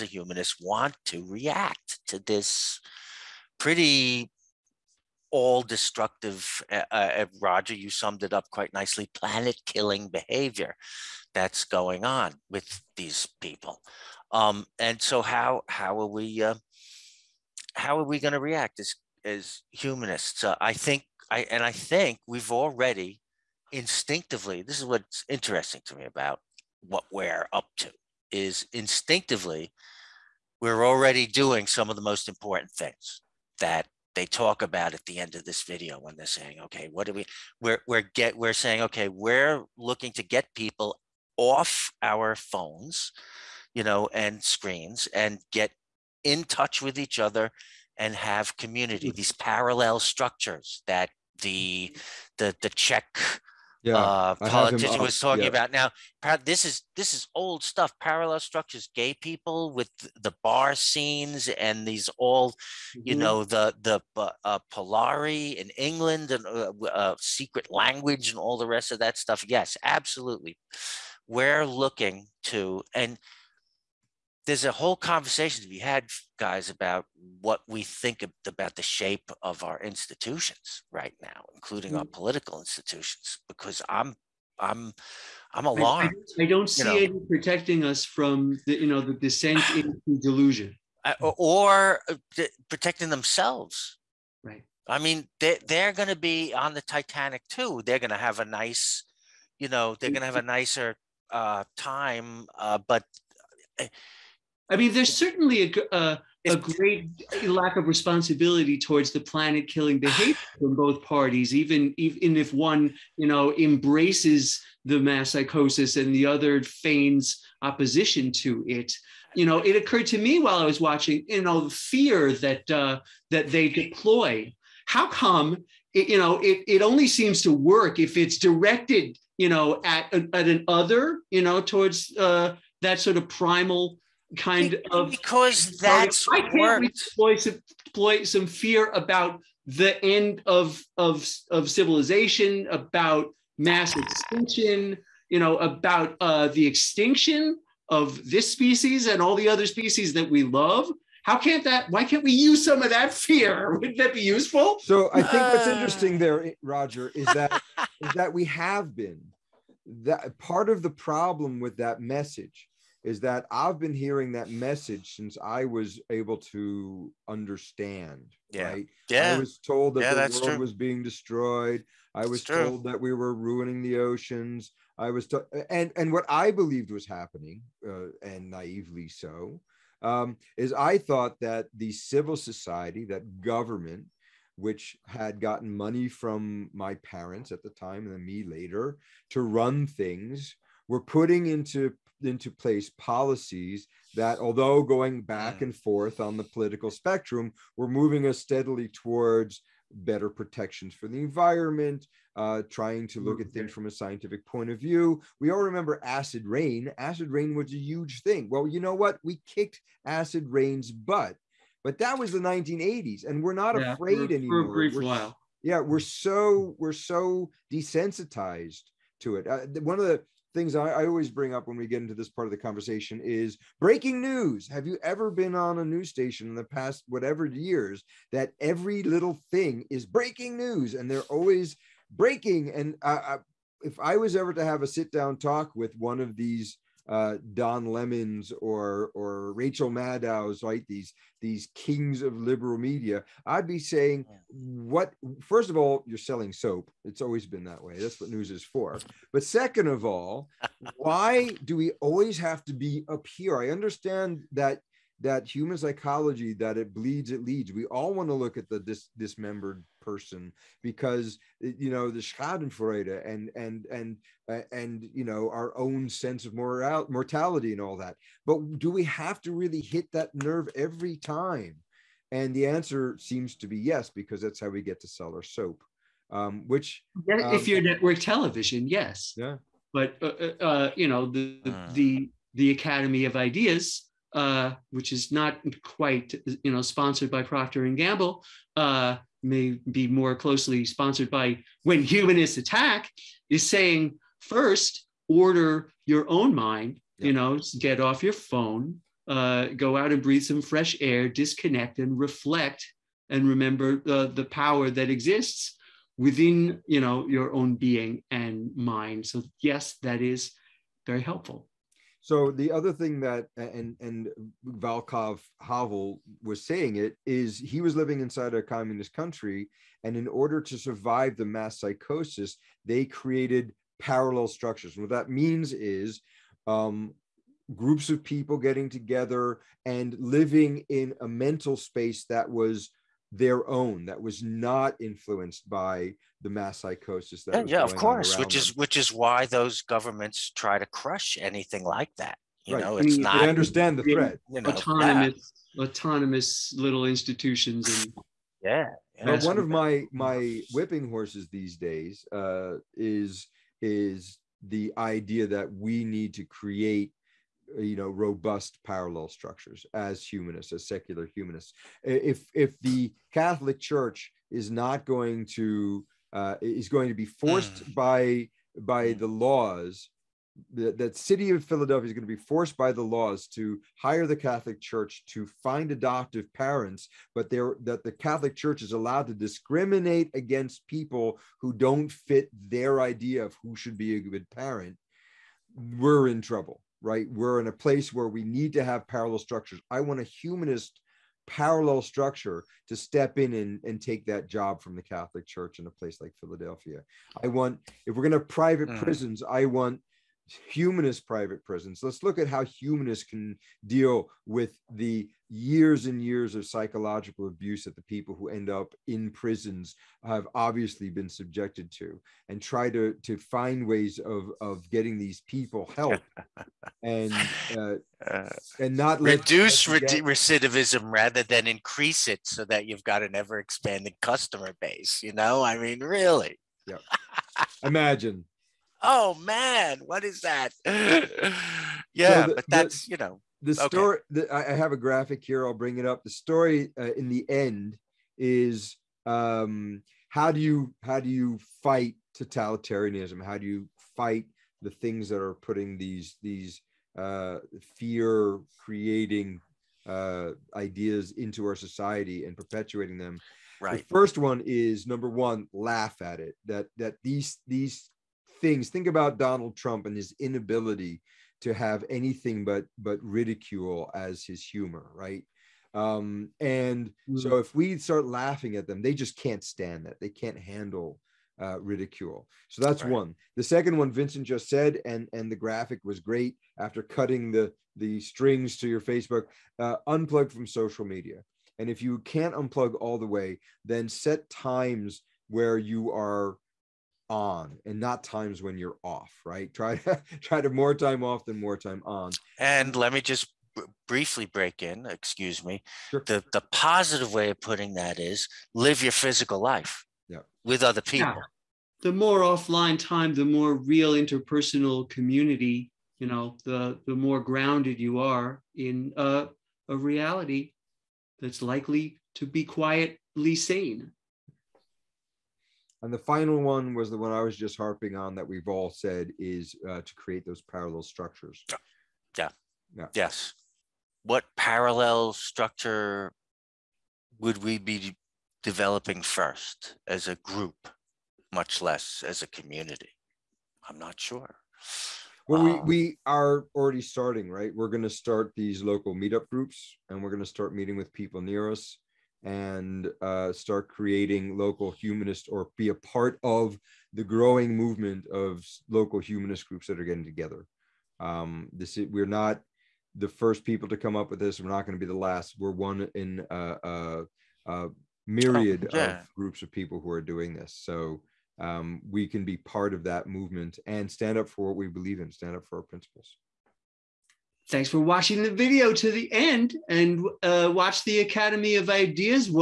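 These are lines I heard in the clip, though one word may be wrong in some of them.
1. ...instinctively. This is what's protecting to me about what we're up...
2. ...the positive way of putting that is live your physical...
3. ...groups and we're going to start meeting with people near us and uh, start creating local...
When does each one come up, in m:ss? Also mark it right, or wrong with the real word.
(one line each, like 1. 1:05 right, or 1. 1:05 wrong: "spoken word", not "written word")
1. 0:23 wrong: "interesting", not "protecting"
2. 8:16 right
3. 8:59 right.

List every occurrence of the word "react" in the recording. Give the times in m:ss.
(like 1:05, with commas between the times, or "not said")
0:01, 0:18.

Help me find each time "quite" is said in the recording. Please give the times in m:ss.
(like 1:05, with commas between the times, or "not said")
0:08, 4:45.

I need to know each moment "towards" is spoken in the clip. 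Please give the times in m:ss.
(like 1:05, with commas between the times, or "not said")
1:48, 2:11, 3:18.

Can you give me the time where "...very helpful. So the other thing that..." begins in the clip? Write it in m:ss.
5:11.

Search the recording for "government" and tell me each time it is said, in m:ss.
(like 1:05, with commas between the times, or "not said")
3:03, 5:39.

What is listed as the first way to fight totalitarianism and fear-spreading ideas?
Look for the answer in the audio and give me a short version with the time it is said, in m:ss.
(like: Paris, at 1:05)
Laugh at it, at 7:35.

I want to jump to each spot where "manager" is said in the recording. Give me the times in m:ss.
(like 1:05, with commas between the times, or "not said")
not said.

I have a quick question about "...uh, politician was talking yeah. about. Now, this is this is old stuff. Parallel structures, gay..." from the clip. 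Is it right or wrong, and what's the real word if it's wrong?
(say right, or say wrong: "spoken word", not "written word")
right.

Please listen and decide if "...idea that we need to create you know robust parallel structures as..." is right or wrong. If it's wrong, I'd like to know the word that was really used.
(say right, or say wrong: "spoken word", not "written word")
right.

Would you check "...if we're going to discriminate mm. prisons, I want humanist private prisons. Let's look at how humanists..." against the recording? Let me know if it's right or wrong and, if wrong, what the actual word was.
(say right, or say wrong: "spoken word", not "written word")
wrong: "private", not "discriminate".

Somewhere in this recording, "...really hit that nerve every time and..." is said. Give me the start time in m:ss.
4:29.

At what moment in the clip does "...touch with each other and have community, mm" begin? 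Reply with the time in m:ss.
0:46.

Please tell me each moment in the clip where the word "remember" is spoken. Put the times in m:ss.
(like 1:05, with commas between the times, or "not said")
3:25, 5:03.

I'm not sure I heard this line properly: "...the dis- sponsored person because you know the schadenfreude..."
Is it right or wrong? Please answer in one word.
wrong.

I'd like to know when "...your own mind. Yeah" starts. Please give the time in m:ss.
4:56.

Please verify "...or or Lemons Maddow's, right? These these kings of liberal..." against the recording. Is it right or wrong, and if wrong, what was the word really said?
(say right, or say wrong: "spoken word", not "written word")
wrong: "Rachel", not "Lemons".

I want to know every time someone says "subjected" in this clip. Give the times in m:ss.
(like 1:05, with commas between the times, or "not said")
6:51.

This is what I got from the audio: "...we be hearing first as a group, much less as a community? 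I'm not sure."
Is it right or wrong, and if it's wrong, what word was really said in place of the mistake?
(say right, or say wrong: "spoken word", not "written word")
wrong: "developing", not "hearing".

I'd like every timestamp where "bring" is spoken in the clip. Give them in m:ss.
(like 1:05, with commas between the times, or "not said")
3:41, 7:15.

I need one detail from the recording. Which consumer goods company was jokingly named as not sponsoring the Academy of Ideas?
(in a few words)
Procter and Gamble.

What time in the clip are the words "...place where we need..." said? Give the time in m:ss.
6:27.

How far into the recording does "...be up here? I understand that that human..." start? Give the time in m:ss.
4:12.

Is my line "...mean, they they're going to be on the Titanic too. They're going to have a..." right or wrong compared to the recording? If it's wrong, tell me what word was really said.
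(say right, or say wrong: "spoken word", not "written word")
right.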